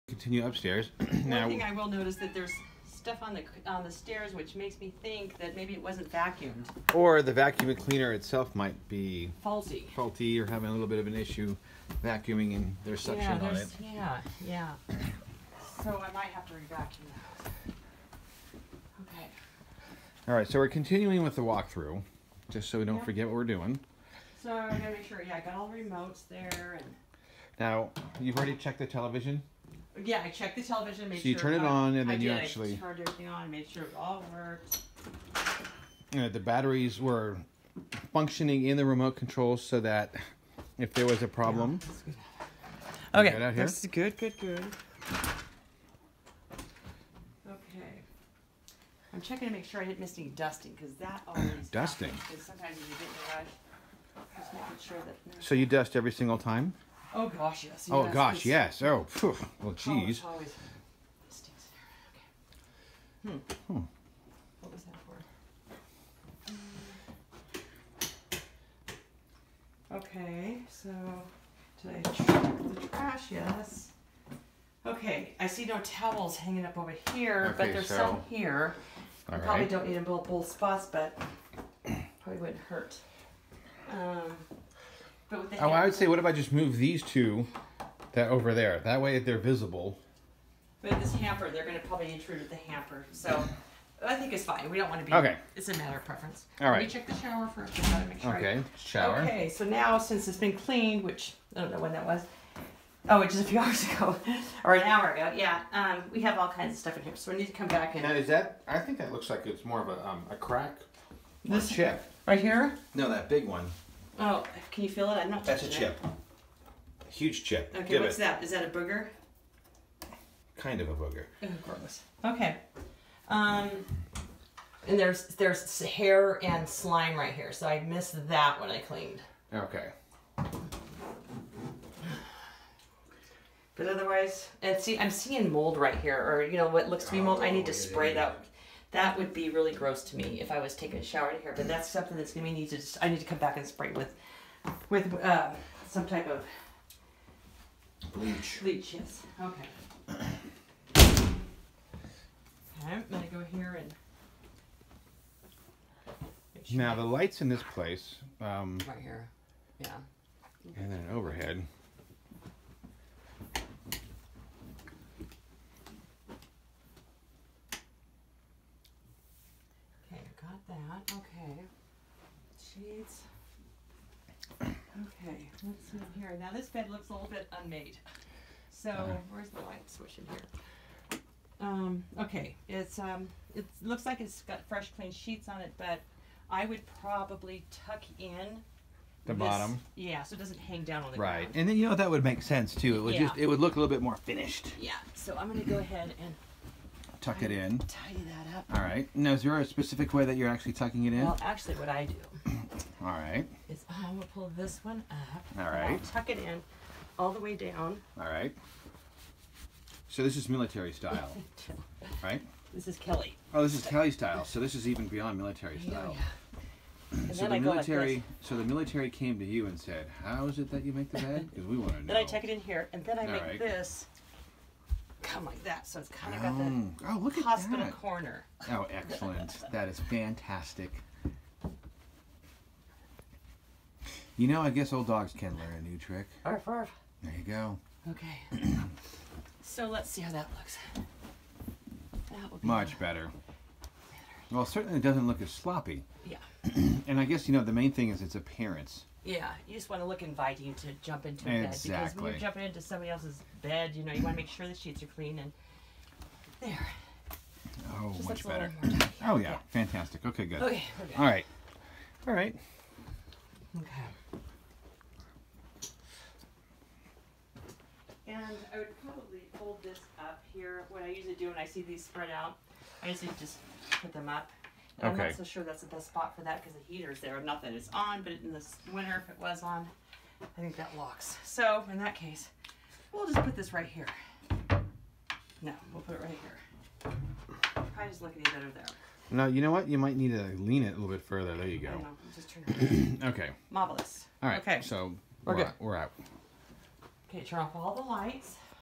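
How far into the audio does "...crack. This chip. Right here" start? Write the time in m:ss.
1:50.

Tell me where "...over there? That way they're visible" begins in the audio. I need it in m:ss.
1:28.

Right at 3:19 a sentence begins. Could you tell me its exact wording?
Now, is there a specific way that you're actually tucking it in?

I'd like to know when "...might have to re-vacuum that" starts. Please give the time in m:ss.
0:16.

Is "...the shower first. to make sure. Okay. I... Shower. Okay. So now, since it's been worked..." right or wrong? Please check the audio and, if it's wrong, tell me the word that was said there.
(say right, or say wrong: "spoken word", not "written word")
wrong: "cleaned", not "worked".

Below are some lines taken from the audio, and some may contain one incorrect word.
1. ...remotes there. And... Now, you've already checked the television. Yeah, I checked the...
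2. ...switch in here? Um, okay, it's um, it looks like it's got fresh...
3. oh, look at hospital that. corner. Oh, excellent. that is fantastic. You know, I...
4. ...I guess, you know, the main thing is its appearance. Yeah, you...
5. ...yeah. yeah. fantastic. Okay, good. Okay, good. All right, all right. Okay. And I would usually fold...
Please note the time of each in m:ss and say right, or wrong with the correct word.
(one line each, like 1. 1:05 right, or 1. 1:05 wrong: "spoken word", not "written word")
1. 0:25 right
2. 2:59 right
3. 3:47 right
4. 4:07 right
5. 4:19 wrong: "probably", not "usually".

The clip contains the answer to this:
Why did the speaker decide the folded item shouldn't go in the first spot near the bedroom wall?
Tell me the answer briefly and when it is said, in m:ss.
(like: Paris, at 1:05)
The heater's there, at 4:36.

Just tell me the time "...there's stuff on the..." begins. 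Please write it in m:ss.
0:02.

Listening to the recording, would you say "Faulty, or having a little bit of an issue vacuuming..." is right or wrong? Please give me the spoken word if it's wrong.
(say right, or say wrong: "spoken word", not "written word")
right.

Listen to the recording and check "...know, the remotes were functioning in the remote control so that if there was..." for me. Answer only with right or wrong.
wrong.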